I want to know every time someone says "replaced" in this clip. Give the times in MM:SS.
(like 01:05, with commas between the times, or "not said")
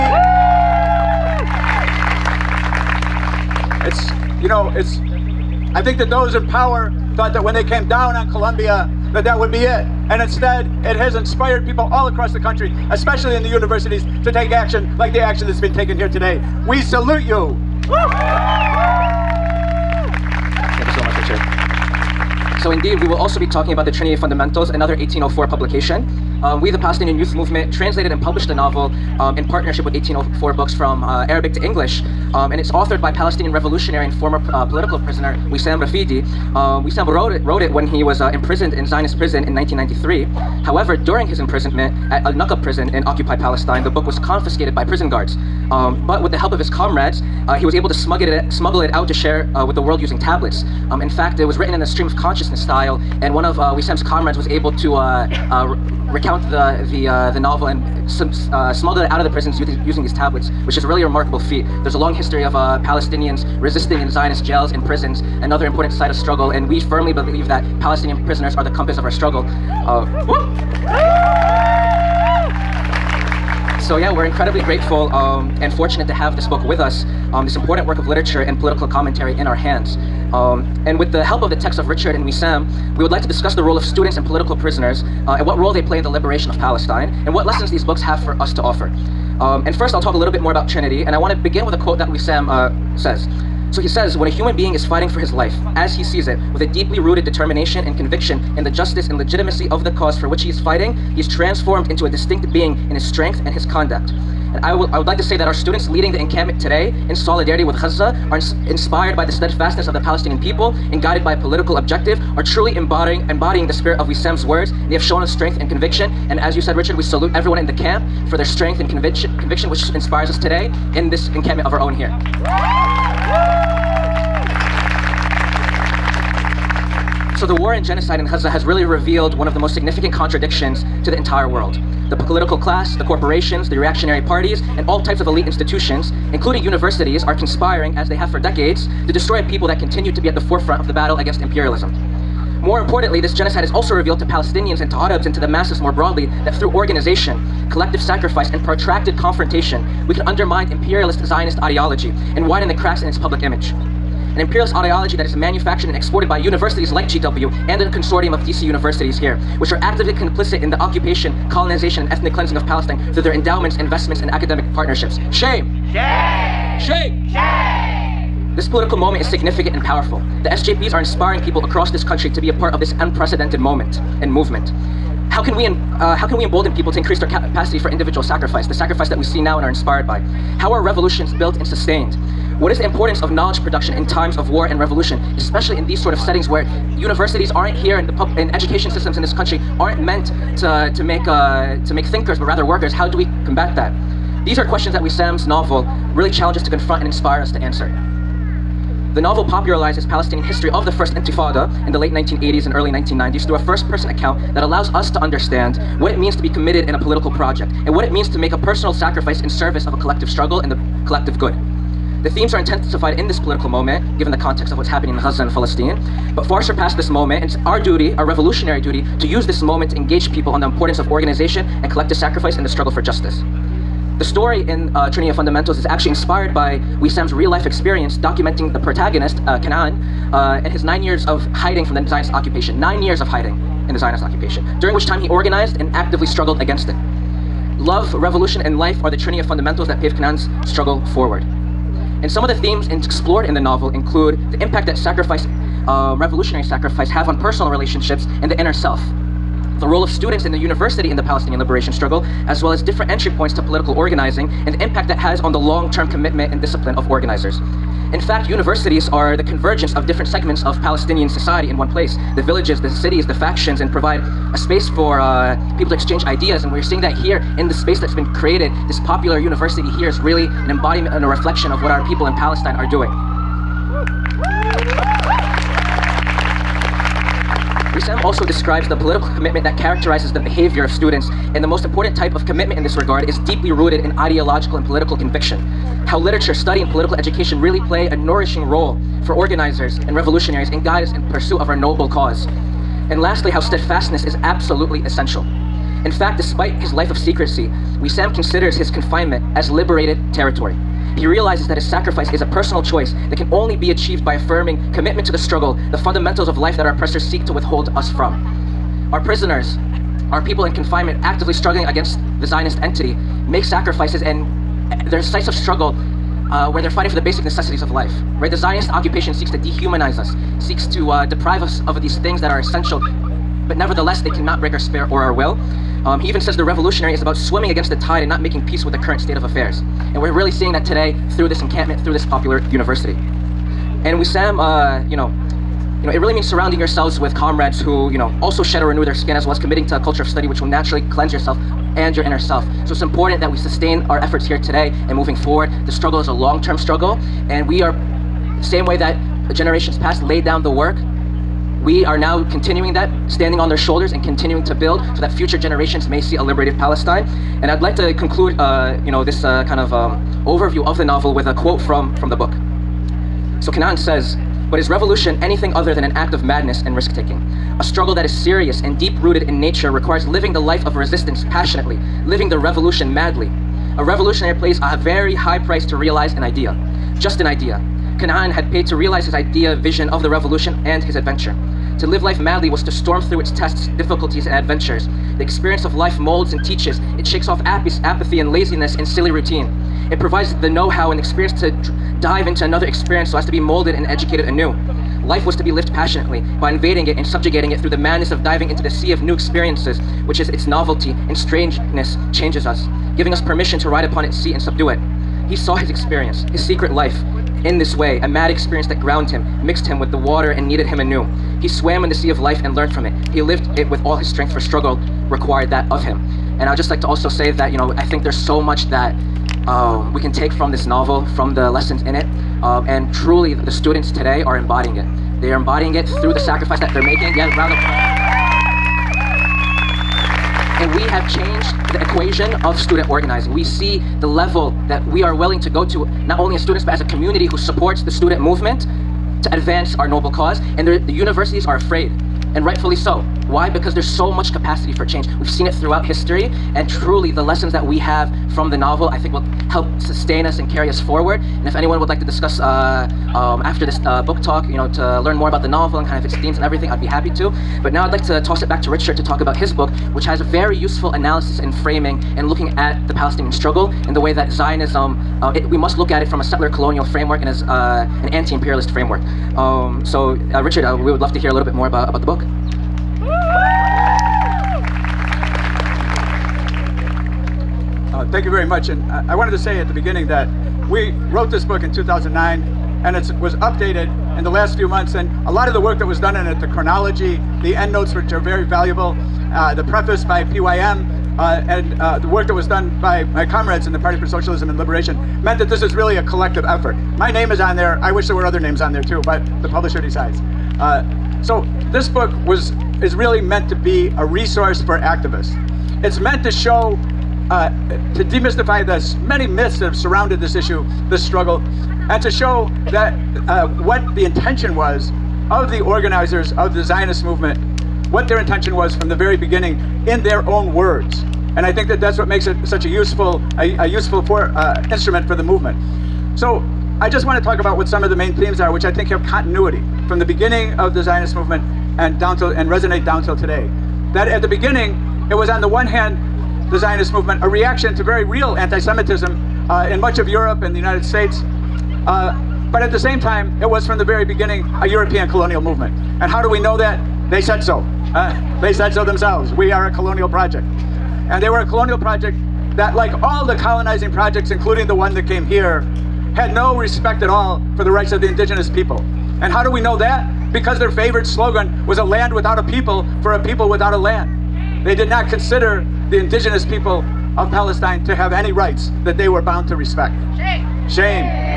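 not said.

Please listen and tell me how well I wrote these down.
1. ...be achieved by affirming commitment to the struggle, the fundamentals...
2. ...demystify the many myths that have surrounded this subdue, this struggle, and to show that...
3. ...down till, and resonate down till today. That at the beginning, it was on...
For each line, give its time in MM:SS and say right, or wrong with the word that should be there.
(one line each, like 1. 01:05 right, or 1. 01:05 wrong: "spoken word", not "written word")
1. 05:03 right
2. 08:28 wrong: "issue", not "subdue"
3. 08:52 right.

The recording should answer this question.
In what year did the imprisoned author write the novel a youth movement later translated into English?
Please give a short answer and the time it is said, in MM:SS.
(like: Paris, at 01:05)
1993, at 00:39.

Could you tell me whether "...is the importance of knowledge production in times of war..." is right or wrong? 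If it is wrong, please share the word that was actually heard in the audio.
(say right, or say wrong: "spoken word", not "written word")
right.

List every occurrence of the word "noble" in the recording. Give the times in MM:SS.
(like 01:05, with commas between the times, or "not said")
04:51, 07:20.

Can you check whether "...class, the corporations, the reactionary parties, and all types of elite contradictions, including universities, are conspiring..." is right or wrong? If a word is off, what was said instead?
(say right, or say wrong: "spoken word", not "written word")
wrong: "institutions", not "contradictions".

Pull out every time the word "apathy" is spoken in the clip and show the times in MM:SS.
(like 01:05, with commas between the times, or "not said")
06:28.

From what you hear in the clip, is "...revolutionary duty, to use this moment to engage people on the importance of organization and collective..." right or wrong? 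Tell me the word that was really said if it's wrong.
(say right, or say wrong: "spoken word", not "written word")
right.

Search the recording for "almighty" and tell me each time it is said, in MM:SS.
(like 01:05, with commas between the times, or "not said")
not said.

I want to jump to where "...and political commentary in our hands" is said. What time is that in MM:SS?
01:18.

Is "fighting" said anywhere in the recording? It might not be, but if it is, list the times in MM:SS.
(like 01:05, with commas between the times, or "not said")
01:34, 01:40, 05:16.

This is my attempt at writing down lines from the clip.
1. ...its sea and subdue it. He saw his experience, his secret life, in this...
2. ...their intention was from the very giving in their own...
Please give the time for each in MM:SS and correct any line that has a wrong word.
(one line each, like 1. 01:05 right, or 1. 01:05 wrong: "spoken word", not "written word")
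1. 06:44 right
2. 08:38 wrong: "beginning", not "giving".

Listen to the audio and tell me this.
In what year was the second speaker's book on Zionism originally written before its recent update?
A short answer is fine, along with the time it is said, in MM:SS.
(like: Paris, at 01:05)
2009, at 08:01.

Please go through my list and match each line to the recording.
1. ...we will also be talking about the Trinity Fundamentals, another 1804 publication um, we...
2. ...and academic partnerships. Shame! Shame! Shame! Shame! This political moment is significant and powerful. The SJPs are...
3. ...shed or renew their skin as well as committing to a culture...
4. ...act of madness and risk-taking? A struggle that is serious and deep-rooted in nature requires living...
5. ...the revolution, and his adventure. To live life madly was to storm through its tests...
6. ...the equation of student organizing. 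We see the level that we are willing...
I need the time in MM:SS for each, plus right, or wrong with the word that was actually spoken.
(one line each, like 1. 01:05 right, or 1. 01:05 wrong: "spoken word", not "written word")
1. 00:23 right
2. 02:44 right
3. 05:38 right
4. 06:06 right
5. 06:20 right
6. 07:11 right.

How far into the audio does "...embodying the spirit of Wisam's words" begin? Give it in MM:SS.
01:53.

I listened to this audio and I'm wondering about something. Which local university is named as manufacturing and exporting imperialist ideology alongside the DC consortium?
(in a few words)
GW.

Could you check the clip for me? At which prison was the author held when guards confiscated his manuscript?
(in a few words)
Al Naqab.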